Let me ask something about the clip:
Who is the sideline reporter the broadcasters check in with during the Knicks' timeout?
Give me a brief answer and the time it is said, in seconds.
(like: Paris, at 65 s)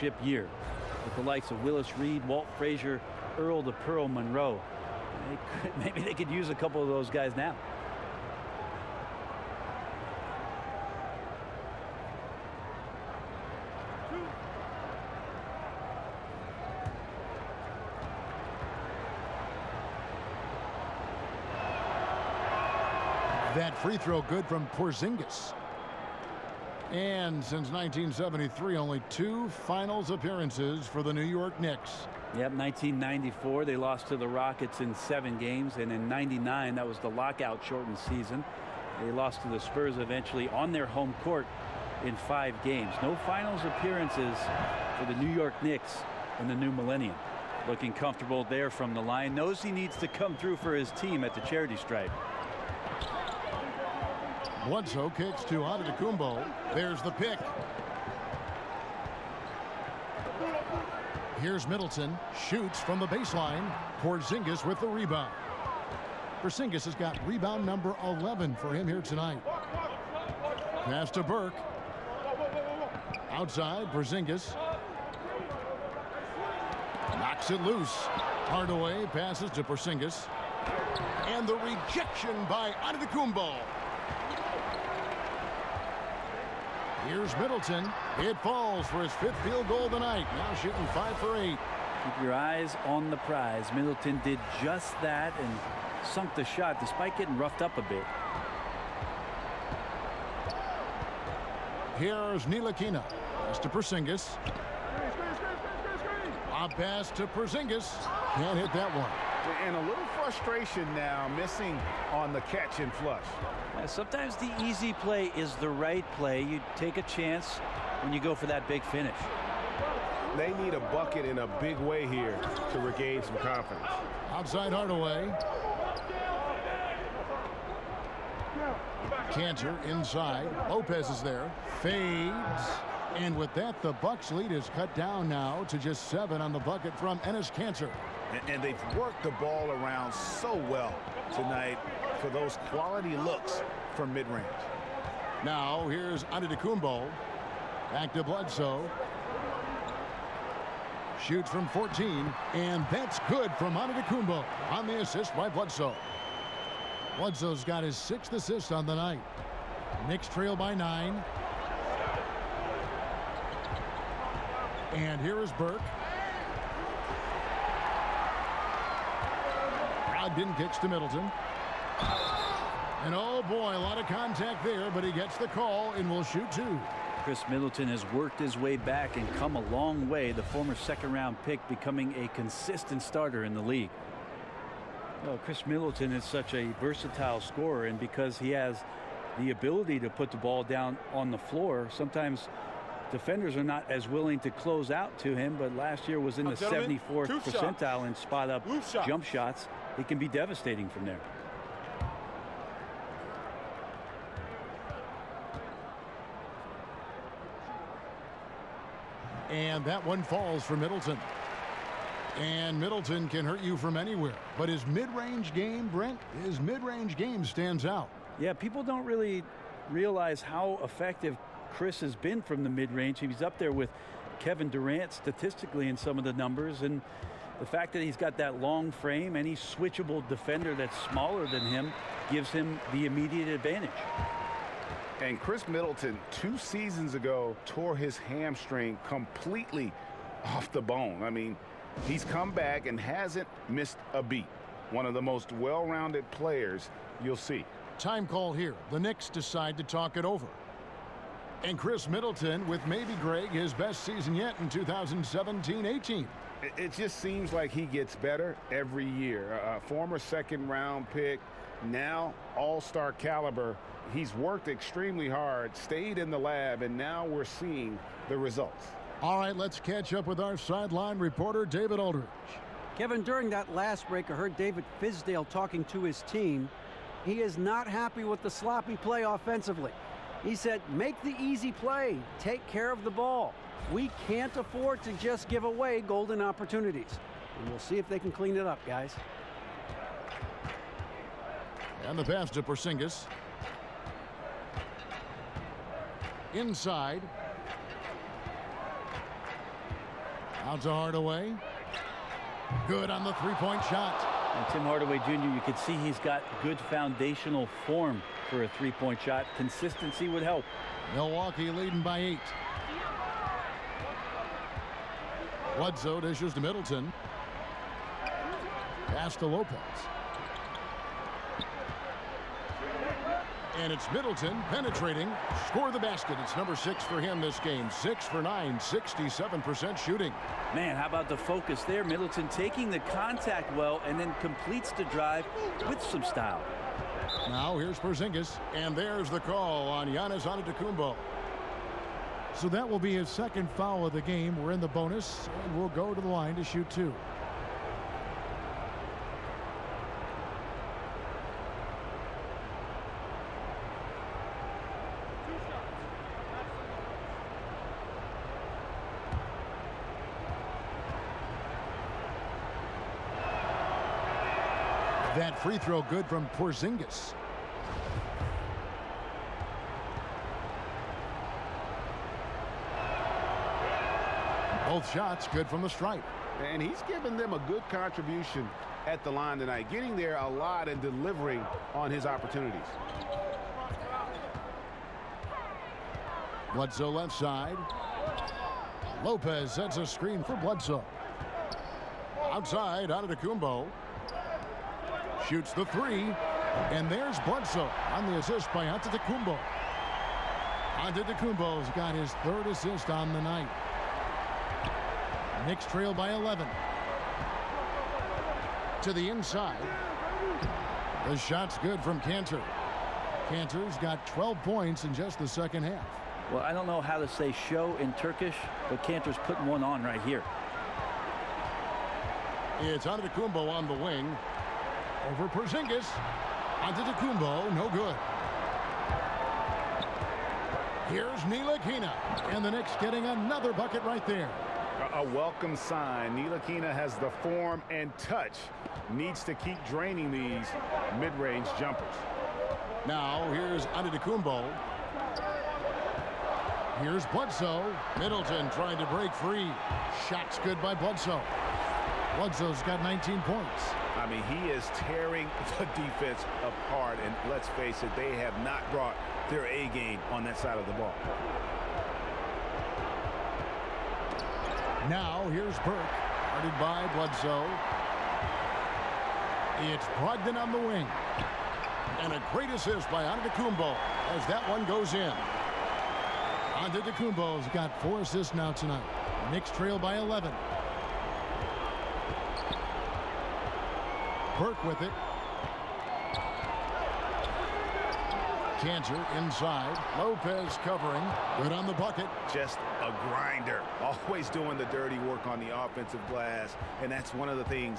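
David Aldridge, at 271 s.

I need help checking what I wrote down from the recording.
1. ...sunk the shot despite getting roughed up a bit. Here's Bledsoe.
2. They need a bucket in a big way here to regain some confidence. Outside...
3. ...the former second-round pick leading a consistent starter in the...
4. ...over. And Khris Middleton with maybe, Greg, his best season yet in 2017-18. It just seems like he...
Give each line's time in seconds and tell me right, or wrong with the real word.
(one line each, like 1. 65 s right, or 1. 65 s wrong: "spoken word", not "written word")
1. 96 s wrong: "Ntilikina", not "Bledsoe"
2. 120 s right
3. 180 s wrong: "becoming", not "leading"
4. 250 s right.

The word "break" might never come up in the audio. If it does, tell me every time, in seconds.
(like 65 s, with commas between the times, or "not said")
274 s, 449 s.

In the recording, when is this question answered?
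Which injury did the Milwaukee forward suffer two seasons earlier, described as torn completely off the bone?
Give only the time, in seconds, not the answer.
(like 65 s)
238 s.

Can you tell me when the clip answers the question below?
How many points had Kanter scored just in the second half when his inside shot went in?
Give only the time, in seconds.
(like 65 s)
414 s.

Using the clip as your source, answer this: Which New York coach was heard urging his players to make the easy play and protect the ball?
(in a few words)
David Fizdale.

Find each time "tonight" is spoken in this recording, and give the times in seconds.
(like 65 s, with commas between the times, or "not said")
69 s, 141 s, 379 s, 478 s.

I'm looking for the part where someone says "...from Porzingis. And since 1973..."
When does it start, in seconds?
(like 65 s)
24 s.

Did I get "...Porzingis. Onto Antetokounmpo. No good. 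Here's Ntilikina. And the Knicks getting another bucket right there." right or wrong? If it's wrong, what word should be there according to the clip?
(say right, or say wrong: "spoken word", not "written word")
right.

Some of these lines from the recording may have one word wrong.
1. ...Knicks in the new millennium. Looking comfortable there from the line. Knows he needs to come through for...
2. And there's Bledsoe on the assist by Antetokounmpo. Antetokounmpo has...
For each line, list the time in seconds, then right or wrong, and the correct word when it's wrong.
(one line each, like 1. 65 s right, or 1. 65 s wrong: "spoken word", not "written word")
1. 45 s right
2. 396 s right.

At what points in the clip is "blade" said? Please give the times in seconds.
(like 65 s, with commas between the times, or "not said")
not said.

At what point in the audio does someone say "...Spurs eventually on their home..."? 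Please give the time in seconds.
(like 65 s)
39 s.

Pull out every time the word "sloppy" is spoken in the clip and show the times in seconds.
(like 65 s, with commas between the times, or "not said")
278 s.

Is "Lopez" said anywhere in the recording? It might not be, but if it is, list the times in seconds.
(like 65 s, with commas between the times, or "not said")
130 s, 319 s, 389 s, 490 s.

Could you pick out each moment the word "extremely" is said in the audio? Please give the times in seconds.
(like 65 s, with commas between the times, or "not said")
264 s.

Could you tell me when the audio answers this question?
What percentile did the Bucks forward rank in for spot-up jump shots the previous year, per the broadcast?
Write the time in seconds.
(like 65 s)
196 s.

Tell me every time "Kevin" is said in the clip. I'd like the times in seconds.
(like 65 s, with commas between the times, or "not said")
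224 s, 272 s.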